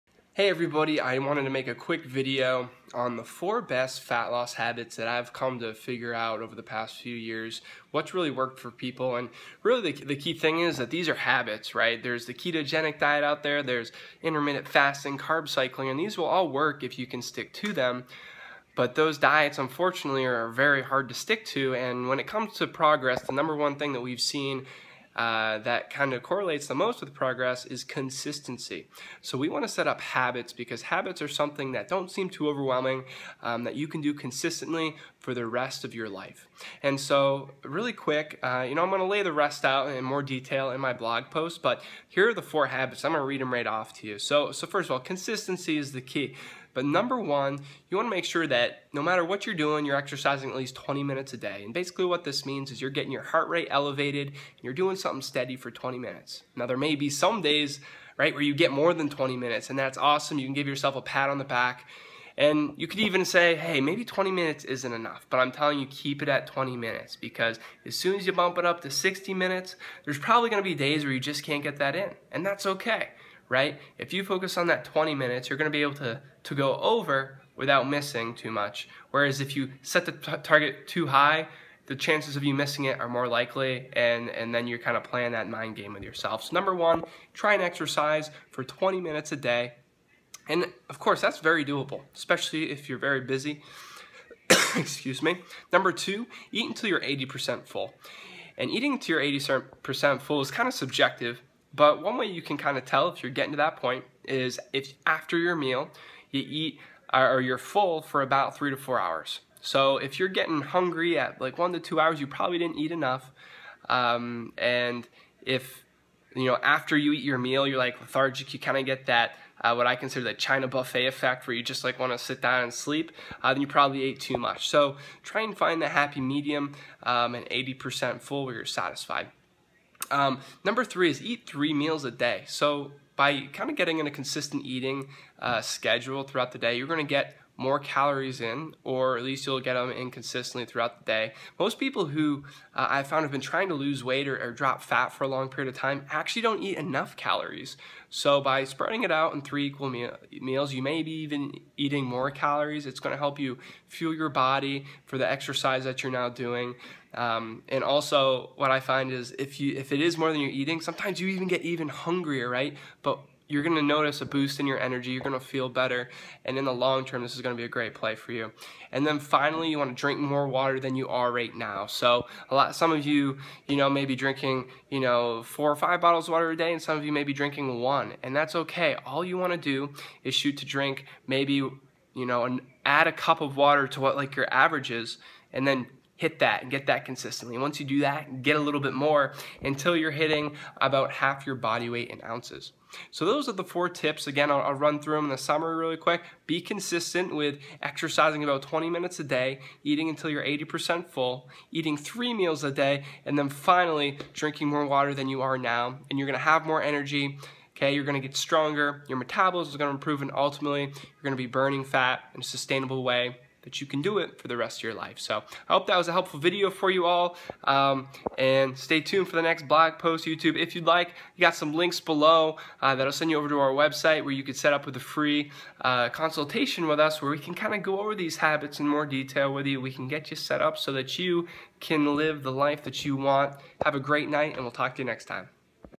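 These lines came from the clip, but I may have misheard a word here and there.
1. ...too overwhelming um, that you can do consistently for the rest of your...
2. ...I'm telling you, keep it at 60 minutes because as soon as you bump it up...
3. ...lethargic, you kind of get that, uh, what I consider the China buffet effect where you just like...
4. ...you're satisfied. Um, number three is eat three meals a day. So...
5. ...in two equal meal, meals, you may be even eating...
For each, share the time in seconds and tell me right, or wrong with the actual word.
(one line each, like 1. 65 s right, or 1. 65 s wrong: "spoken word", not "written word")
1. 32 s right
2. 65 s wrong: "20", not "60"
3. 117 s right
4. 128 s right
5. 149 s wrong: "three", not "two".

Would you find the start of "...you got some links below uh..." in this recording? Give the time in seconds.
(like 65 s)
221 s.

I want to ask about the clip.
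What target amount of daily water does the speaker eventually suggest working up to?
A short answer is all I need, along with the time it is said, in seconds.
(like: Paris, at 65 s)
Half your body weight in ounces, at 191 s.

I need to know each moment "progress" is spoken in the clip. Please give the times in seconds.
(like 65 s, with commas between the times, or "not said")
22 s, 27 s.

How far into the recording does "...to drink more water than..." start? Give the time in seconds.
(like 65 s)
169 s.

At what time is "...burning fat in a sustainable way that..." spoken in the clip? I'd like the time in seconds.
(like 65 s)
211 s.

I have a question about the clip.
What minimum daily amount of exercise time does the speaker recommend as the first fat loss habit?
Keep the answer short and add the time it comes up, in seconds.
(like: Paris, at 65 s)
20 minutes, at 50 s.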